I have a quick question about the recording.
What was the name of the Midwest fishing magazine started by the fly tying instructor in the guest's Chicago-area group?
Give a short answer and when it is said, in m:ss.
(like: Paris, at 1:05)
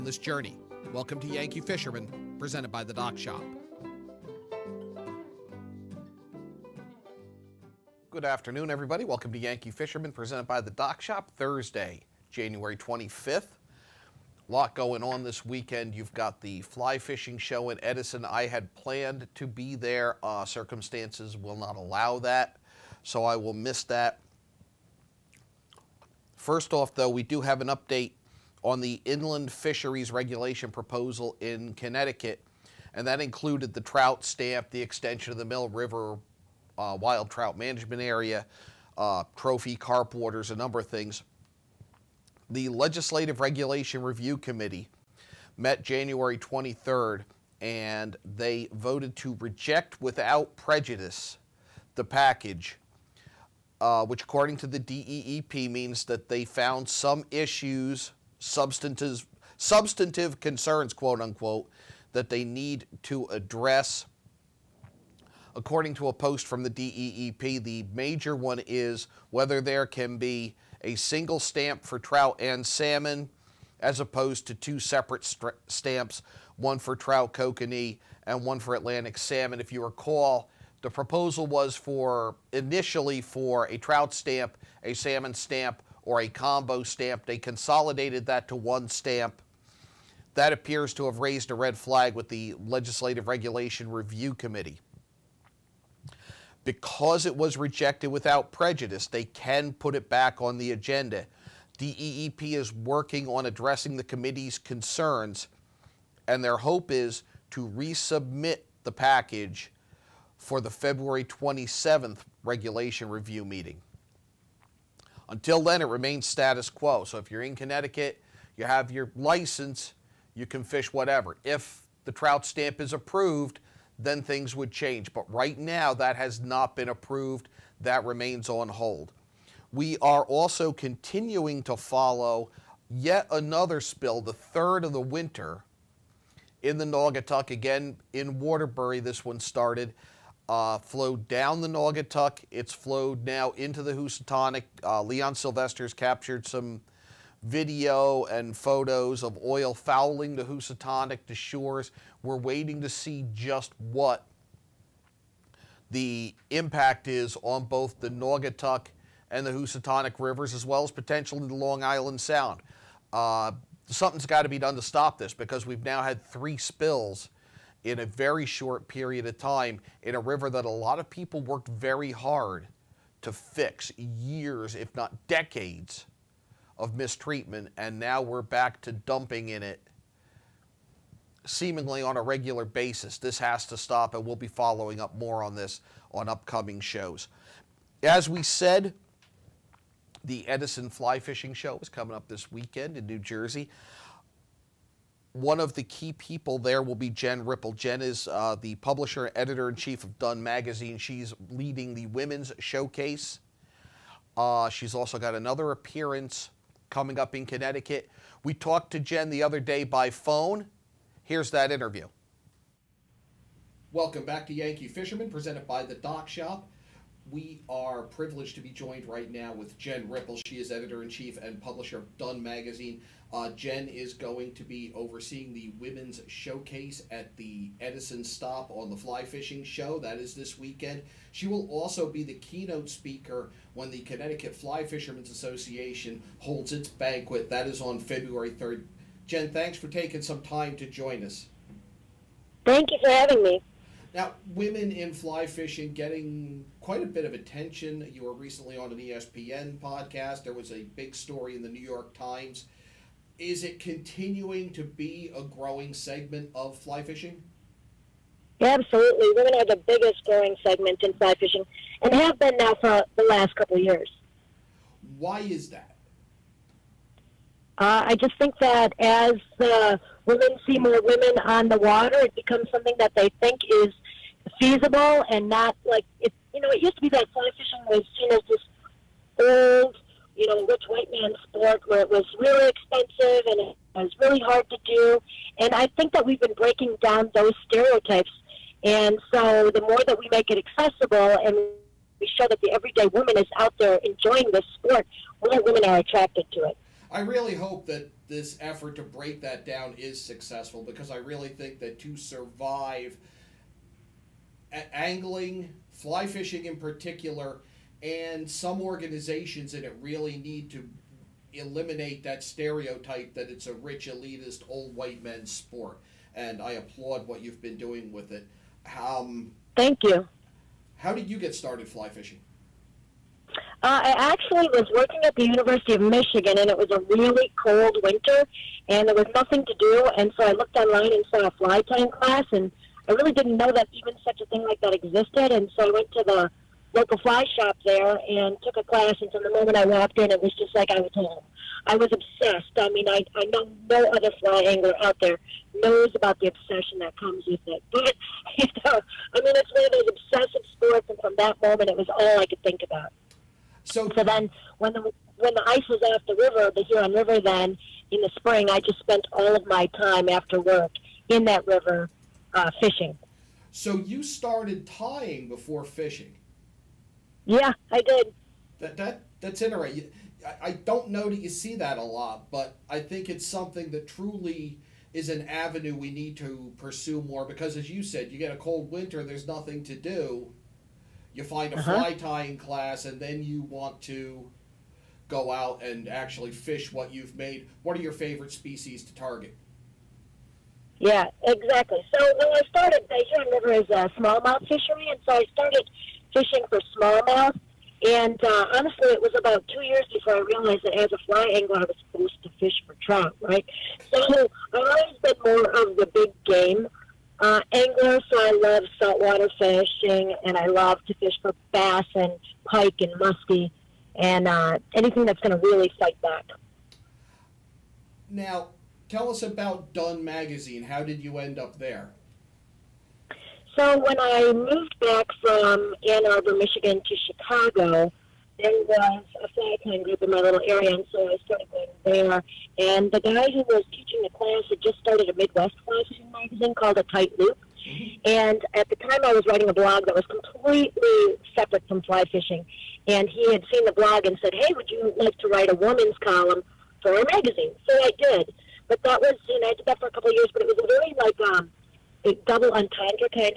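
A Tight Loop, at 7:16.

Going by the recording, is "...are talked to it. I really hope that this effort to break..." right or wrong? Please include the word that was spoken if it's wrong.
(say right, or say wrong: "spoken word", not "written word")
wrong: "attracted", not "talked".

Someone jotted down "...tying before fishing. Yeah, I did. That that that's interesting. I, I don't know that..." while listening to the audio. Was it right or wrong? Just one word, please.
right.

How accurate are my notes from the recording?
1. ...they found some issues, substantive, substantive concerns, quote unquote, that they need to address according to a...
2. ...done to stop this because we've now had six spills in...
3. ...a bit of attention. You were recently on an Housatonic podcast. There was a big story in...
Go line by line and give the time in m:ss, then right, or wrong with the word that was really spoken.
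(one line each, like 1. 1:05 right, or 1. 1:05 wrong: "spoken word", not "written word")
1. 0:56 right
2. 2:44 wrong: "three", not "six"
3. 4:07 wrong: "ESPN", not "Housatonic".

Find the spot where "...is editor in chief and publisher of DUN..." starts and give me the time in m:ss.
3:40.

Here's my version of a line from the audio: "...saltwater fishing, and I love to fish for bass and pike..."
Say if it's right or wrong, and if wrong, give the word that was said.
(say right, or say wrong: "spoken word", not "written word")
right.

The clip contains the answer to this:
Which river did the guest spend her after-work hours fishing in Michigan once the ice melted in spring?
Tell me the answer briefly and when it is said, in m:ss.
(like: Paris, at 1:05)
Huron River, at 5:56.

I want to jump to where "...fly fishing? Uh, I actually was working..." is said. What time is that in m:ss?
5:21.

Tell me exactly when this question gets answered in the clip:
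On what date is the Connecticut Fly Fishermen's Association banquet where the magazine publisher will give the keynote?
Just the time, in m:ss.
3:57.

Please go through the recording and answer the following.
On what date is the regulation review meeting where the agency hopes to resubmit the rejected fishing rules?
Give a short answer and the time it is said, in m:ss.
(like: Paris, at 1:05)
February 27, at 1:50.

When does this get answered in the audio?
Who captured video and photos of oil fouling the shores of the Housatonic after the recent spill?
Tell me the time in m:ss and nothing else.
2:25.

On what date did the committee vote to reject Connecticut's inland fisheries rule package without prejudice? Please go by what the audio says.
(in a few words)
January 23.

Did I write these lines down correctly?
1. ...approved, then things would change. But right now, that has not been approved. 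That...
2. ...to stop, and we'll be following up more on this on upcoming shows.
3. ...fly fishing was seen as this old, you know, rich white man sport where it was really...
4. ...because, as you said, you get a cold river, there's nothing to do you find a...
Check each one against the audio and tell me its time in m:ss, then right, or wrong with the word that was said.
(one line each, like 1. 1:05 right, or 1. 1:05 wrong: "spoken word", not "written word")
1. 2:02 right
2. 3:03 right
3. 4:37 right
4. 6:17 wrong: "winter", not "river".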